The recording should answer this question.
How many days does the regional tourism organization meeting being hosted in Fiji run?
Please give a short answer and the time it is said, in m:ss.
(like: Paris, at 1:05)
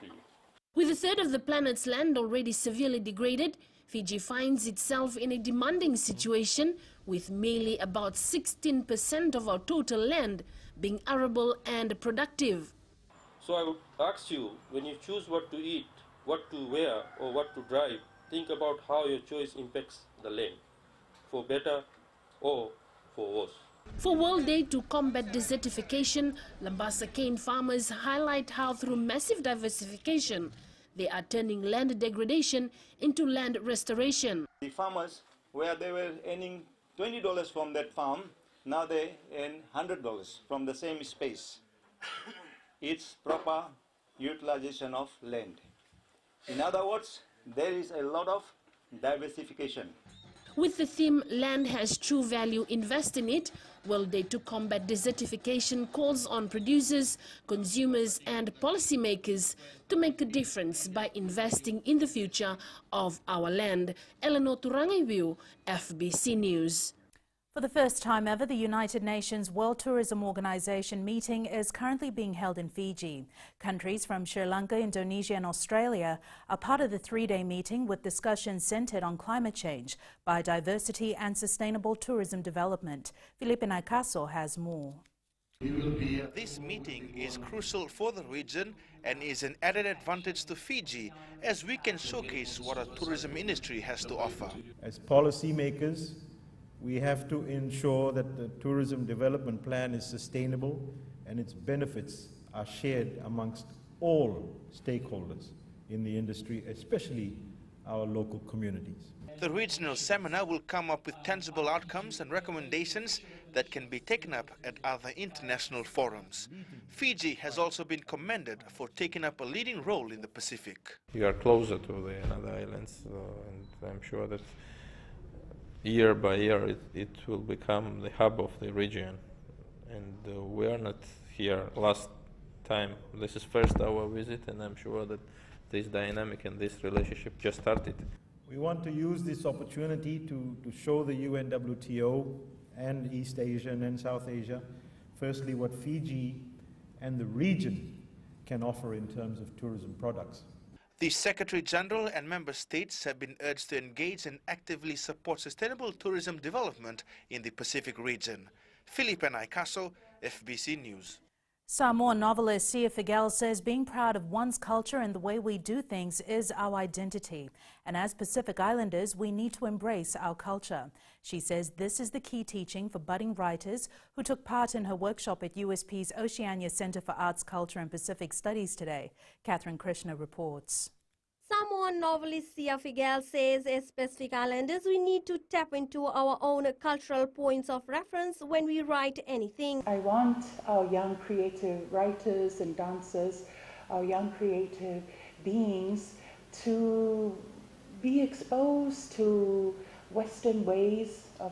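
3, at 1:16.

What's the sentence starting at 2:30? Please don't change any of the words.
The Secretary General and member states have been urged to engage and actively support sustainable tourism development in the Pacific region.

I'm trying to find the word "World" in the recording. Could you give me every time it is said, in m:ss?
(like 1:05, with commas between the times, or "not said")
0:24, 1:09.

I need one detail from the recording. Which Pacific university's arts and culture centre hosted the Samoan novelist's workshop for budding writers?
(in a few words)
USP.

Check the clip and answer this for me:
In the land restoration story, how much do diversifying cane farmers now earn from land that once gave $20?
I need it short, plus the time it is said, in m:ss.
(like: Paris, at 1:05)
$100, at 0:39.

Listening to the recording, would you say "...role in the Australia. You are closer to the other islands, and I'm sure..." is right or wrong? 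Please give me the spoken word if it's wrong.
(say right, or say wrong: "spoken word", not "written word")
wrong: "Pacific", not "Australia".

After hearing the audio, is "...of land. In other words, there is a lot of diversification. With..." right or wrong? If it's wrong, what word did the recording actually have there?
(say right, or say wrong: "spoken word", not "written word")
right.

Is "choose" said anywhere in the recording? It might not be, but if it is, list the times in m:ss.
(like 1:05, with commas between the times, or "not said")
0:15.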